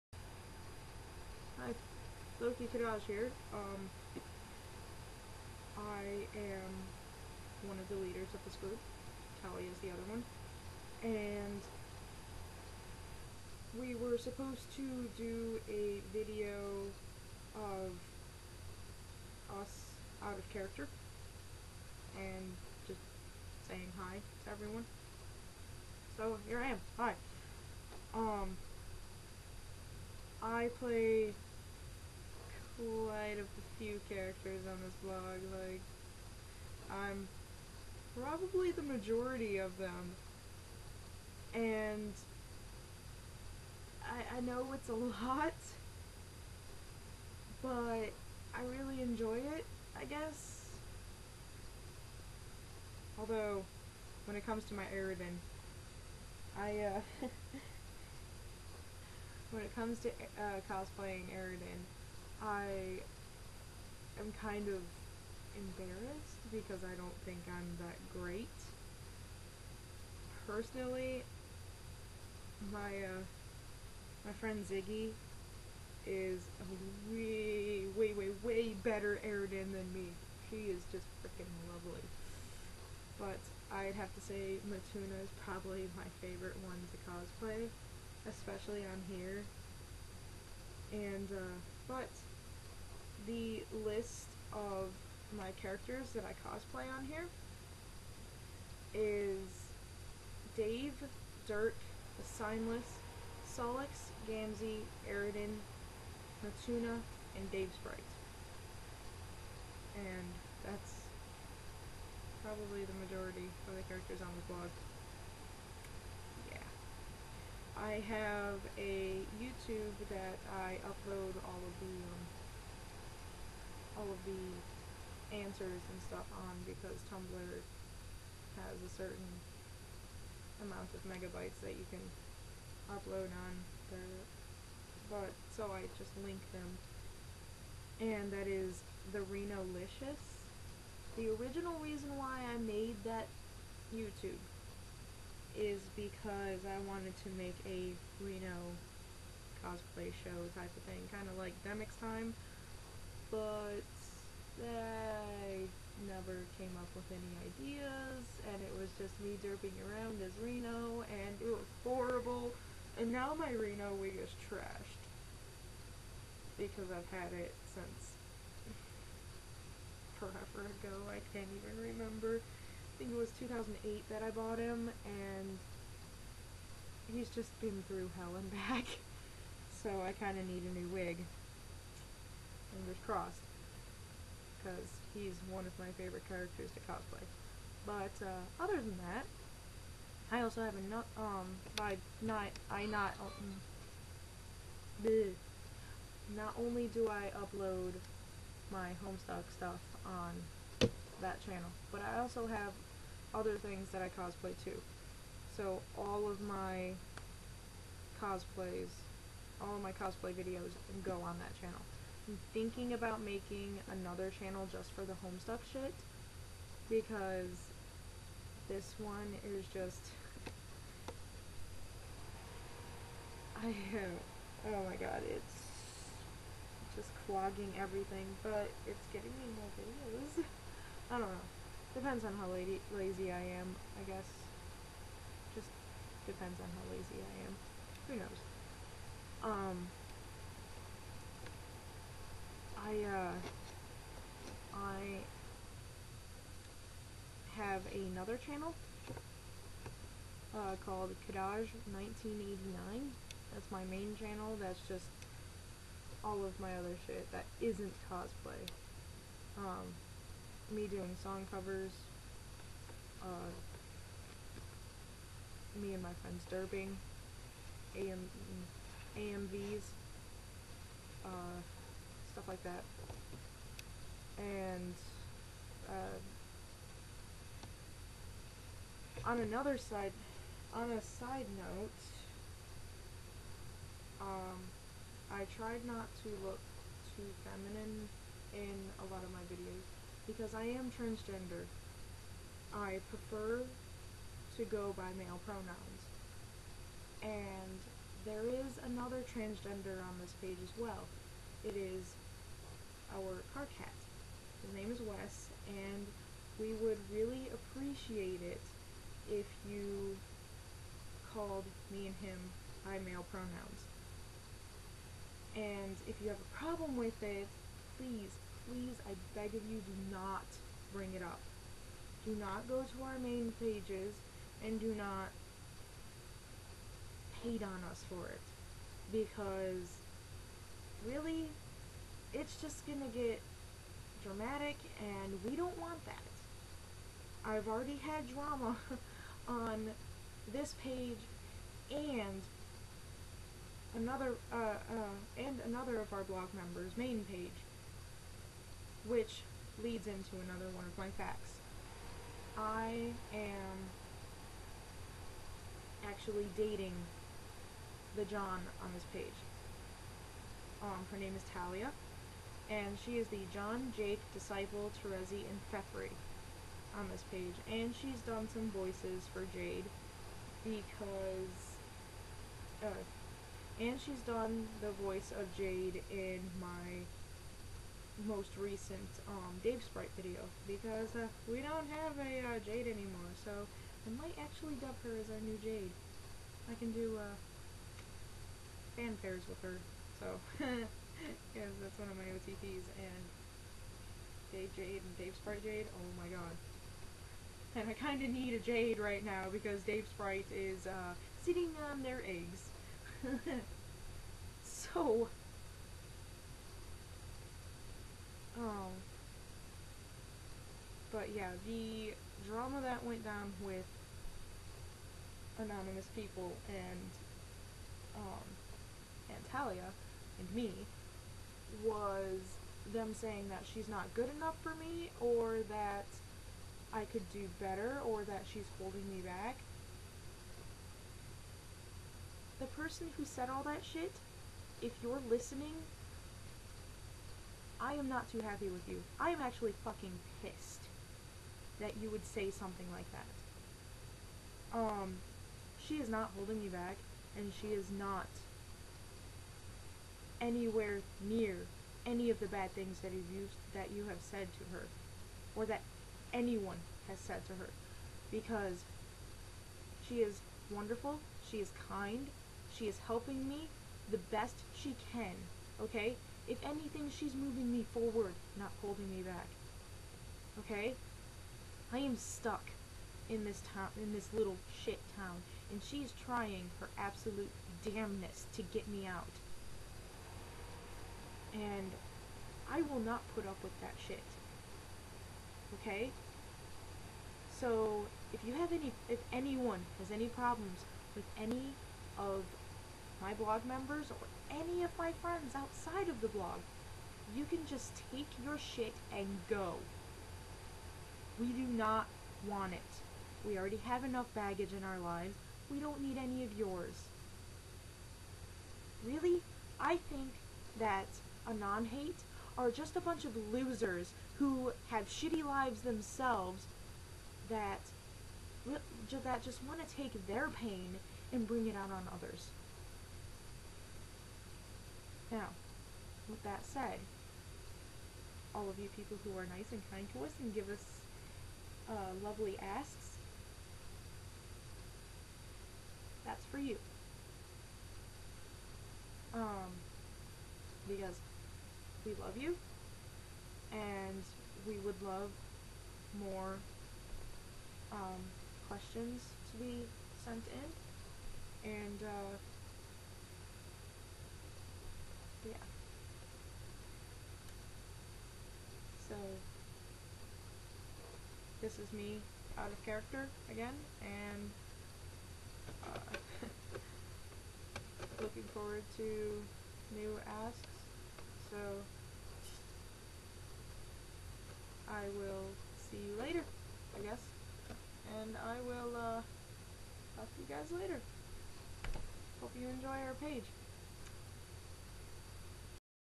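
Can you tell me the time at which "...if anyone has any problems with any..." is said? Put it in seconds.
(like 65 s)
489 s.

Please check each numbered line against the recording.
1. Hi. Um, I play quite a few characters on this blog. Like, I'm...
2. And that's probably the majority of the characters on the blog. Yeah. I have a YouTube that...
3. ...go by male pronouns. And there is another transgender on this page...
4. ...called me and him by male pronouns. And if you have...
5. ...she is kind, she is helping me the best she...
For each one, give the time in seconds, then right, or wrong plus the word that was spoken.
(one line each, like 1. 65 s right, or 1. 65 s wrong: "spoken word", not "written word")
1. 26 s right
2. 109 s right
3. 294 s right
4. 311 s right
5. 461 s right.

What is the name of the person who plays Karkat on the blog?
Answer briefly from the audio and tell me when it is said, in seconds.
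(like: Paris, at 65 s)
Wes, at 305 s.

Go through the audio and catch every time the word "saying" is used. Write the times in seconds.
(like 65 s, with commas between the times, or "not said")
23 s, 423 s.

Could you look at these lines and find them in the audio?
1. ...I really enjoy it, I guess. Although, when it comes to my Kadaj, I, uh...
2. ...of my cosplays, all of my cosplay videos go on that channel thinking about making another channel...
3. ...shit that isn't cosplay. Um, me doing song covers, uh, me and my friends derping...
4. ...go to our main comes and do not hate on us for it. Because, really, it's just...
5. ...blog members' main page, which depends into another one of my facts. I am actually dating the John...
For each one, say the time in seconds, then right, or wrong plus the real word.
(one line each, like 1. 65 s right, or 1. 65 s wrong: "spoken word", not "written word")
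1. 48 s wrong: "Eridan", not "Kadaj"
2. 206 s right
3. 257 s right
4. 322 s wrong: "pages", not "comes"
5. 346 s wrong: "leads", not "depends".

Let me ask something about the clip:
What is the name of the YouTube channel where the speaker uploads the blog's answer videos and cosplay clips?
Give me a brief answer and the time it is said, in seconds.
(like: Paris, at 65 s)
Renolicious, at 139 s.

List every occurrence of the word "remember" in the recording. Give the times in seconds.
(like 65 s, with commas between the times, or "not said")
171 s.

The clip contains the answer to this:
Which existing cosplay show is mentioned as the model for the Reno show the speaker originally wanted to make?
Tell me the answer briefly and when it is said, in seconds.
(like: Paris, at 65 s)
Demix Time, at 151 s.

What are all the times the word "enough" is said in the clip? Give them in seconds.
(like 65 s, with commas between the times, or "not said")
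424 s, 504 s.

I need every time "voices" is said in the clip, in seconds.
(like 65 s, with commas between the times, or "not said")
368 s, 375 s.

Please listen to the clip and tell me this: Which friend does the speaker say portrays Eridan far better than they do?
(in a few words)
Ziggy.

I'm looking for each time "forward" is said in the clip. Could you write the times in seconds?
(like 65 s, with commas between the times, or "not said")
467 s, 568 s.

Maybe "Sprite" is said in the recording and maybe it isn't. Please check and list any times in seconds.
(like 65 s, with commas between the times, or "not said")
107 s, 379 s, 395 s, 400 s.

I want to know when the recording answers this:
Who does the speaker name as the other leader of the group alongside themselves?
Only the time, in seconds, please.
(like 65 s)
9 s.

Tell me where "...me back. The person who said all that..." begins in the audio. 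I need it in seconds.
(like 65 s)
429 s.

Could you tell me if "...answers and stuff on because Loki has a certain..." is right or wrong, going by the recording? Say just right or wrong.
wrong.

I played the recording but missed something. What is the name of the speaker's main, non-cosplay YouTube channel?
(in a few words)
Kadaj 1989.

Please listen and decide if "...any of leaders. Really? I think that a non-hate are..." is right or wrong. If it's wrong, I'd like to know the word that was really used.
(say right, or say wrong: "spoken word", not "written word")
wrong: "yours", not "leaders".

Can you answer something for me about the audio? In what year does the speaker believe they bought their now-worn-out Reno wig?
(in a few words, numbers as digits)
2008.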